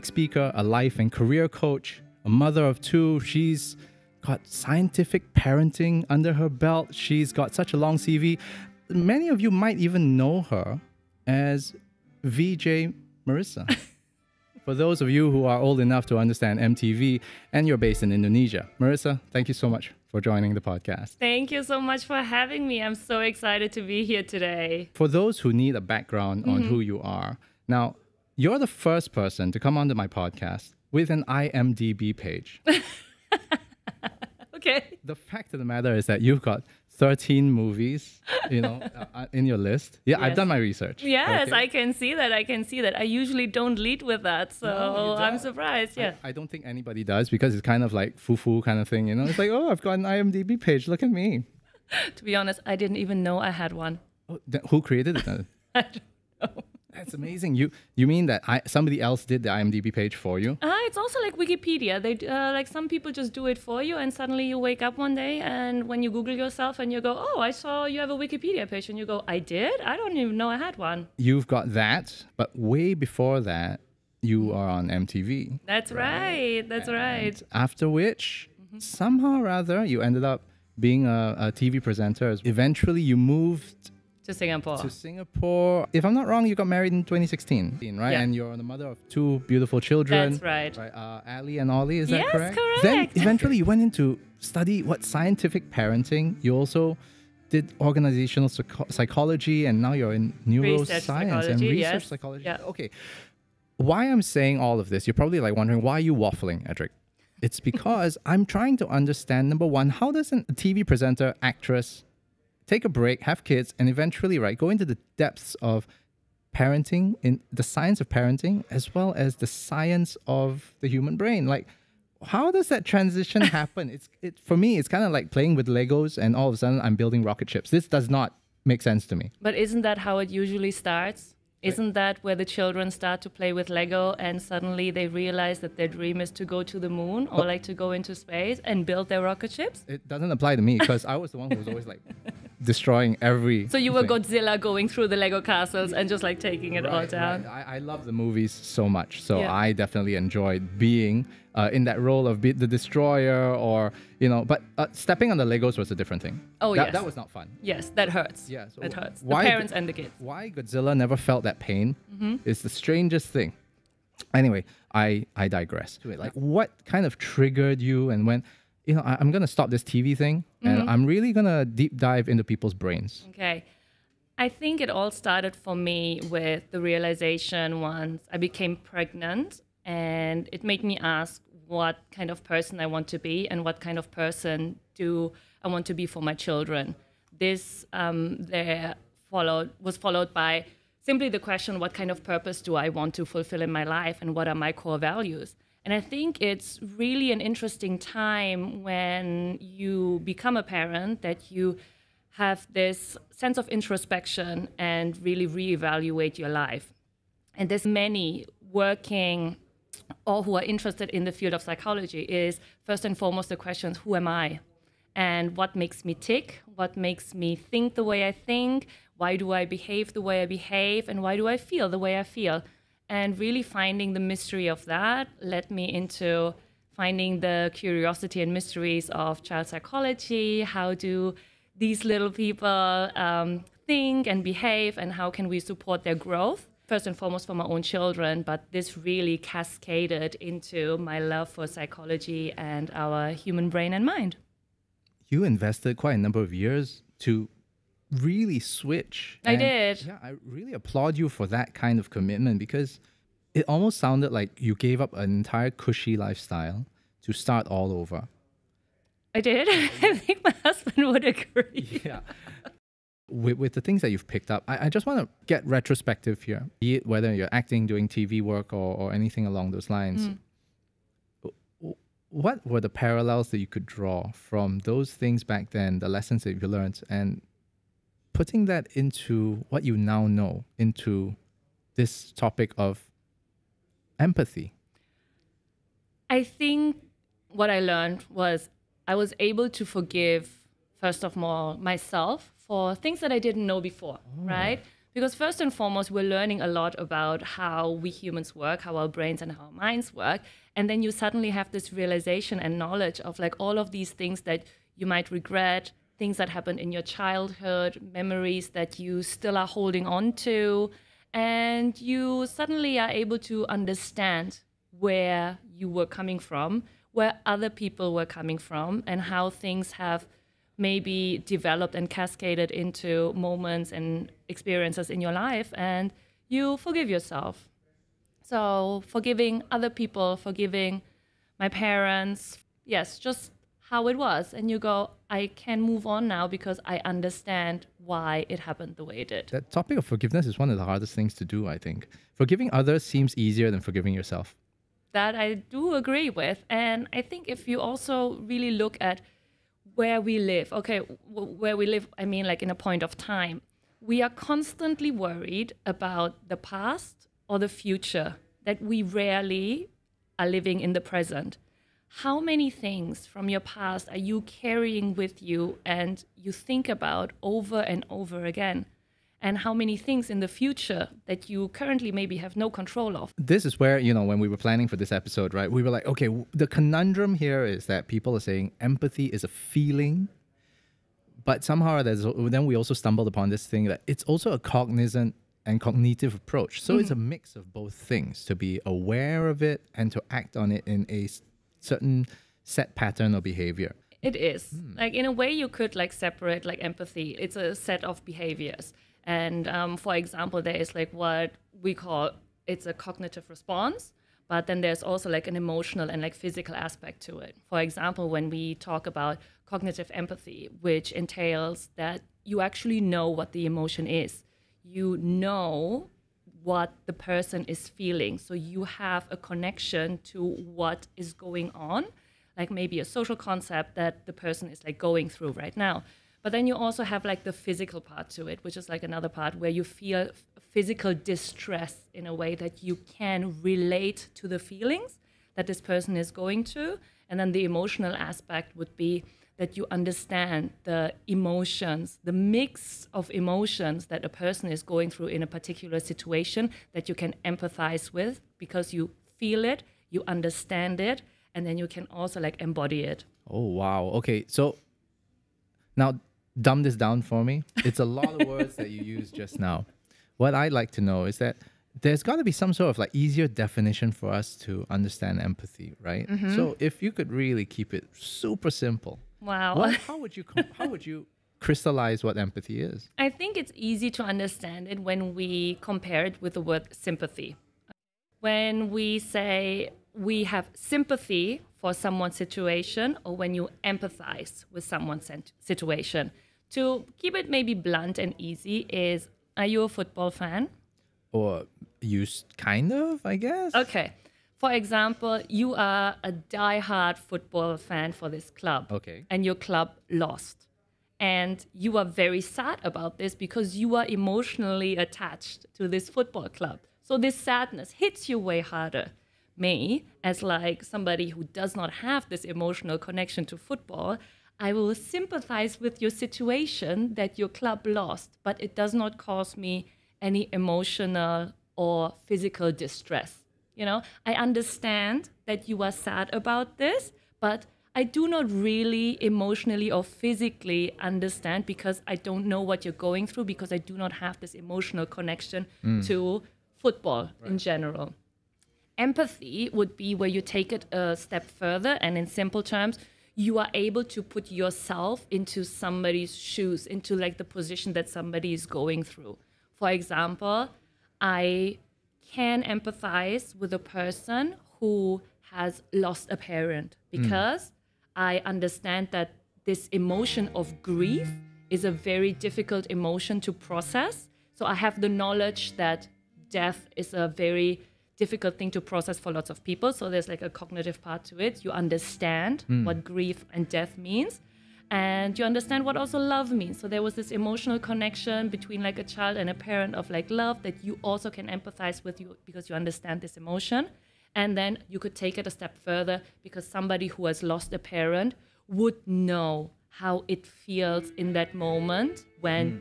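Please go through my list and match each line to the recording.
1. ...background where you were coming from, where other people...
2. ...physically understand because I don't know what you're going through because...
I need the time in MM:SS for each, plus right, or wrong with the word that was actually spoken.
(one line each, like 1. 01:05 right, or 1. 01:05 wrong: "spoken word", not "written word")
1. 05:13 wrong: "understand", not "background"
2. 08:50 right.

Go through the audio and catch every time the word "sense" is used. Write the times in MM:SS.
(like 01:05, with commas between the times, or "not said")
02:08, 03:23.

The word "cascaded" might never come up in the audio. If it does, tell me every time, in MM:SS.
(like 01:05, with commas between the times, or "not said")
03:59, 05:22.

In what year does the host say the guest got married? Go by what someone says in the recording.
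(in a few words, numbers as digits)
2016.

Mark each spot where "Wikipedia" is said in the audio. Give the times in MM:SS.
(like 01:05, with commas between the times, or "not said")
01:01, 01:08.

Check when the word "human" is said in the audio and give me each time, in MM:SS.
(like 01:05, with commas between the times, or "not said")
02:00, 04:03, 04:58.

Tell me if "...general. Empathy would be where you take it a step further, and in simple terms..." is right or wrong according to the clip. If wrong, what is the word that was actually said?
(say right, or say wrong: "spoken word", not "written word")
right.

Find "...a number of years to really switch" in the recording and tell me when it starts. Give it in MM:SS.
04:06.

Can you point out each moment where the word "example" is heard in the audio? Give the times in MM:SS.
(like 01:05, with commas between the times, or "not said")
06:40, 06:47, 08:14, 09:09.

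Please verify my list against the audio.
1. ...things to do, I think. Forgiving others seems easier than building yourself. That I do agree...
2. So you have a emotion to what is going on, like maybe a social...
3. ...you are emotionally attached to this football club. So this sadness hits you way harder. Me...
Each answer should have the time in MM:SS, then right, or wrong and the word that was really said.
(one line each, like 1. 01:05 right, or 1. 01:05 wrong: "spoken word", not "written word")
1. 05:41 wrong: "forgiving", not "building"
2. 06:58 wrong: "connection", not "emotion"
3. 08:23 right.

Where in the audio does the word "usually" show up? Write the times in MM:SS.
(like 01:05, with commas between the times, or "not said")
00:43, 02:10.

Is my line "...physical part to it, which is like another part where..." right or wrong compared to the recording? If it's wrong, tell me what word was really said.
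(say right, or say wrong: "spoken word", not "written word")
right.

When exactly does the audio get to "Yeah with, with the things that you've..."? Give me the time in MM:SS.
04:22.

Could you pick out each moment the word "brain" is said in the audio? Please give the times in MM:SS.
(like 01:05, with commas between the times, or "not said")
02:01, 02:52, 04:03, 04:59.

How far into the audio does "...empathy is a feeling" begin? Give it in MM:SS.
06:18.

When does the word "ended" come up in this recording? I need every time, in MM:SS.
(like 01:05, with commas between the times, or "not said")
01:20.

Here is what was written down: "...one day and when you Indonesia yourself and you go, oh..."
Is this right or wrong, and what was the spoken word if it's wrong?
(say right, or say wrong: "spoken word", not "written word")
wrong: "Google", not "Indonesia".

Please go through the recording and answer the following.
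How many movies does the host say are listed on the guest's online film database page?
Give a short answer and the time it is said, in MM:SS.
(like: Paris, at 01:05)
13, at 00:36.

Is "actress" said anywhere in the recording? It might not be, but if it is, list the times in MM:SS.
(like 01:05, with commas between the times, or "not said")
01:51.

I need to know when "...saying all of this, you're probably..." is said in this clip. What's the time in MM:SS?
01:44.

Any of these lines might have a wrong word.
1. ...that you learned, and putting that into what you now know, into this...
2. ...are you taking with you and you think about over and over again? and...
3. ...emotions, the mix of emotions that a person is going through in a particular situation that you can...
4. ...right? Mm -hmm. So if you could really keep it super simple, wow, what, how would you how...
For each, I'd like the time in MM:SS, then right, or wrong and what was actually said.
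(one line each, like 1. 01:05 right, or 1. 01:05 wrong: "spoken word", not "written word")
1. 04:36 right
2. 06:04 wrong: "carrying", not "taking"
3. 07:21 right
4. 07:45 right.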